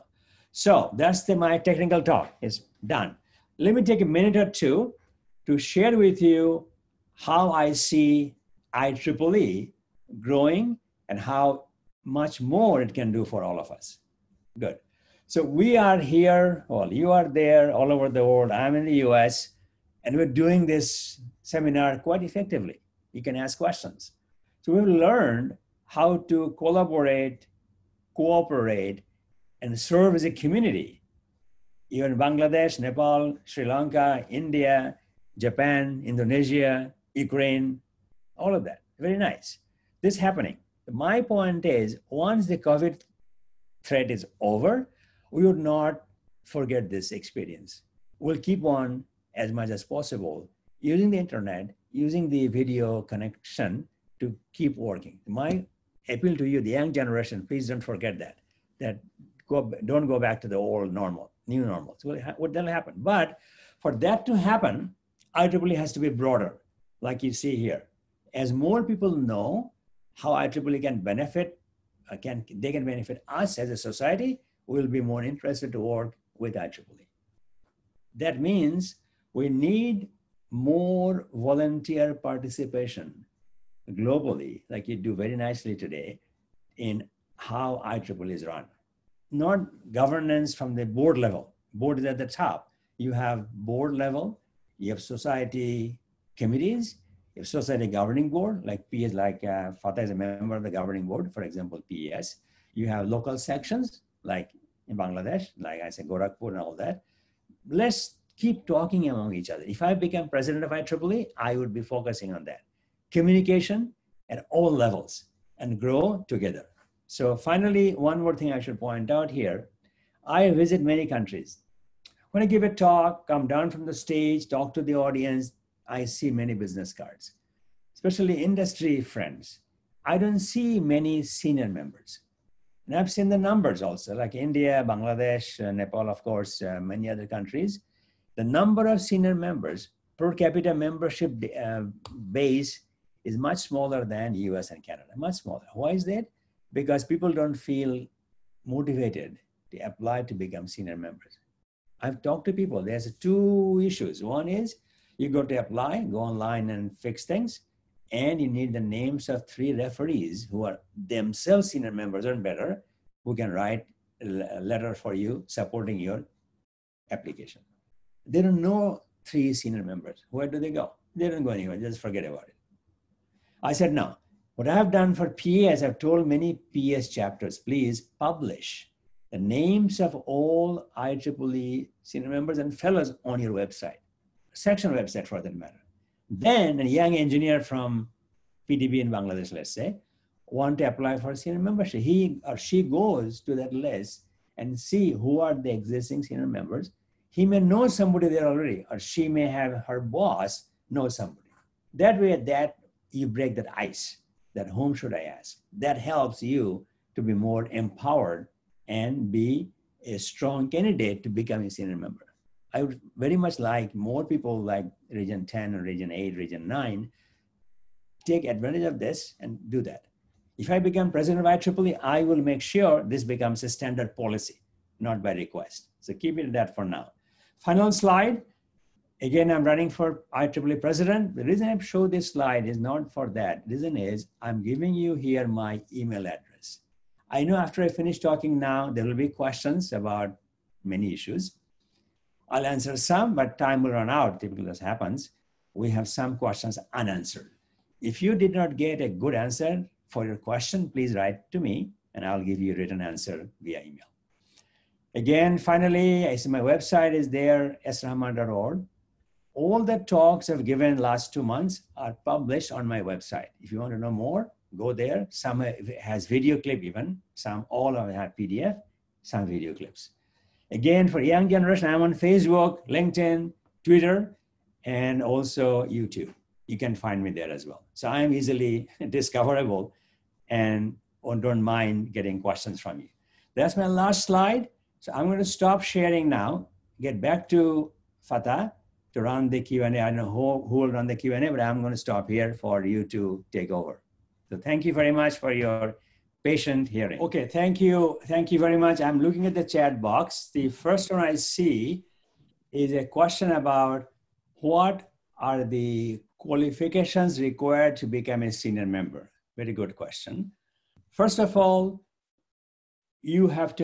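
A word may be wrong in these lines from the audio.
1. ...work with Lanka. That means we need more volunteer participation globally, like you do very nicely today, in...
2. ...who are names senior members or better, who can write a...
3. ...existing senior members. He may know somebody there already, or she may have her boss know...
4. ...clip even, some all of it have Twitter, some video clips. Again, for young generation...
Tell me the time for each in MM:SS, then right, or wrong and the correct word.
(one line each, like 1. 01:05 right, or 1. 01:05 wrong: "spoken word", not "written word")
1. 01:15 wrong: "IEEE", not "Lanka"
2. 02:40 wrong: "themselves", not "names"
3. 03:15 right
4. 04:26 wrong: "PDF", not "Twitter".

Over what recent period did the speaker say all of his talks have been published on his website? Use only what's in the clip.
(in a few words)
Last two months.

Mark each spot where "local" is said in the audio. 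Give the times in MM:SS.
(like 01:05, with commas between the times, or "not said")
01:43.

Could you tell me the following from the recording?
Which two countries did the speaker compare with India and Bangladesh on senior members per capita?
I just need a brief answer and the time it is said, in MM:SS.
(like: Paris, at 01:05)
US and Canada, at 02:24.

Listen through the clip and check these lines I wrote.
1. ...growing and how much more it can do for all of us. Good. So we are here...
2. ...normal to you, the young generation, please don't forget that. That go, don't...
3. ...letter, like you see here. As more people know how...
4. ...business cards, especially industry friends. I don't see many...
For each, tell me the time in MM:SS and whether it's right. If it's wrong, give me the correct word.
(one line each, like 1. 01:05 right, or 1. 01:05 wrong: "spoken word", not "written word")
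1. 00:10 right
2. 00:56 wrong: "appeal", not "normal"
3. 01:06 wrong: "broader", not "letter"
4. 02:06 right.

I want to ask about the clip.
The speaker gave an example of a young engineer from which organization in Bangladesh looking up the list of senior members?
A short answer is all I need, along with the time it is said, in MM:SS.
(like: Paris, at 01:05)
PDB, at 03:08.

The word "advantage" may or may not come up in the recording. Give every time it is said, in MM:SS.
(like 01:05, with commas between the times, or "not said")
03:38.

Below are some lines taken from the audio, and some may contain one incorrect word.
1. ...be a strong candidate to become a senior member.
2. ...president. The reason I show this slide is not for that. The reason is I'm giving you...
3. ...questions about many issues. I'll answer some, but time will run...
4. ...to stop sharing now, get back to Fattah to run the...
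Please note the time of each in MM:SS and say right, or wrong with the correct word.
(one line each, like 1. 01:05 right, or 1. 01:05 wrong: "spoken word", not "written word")
1. 03:29 right
2. 03:50 right
3. 03:59 right
4. 04:45 right.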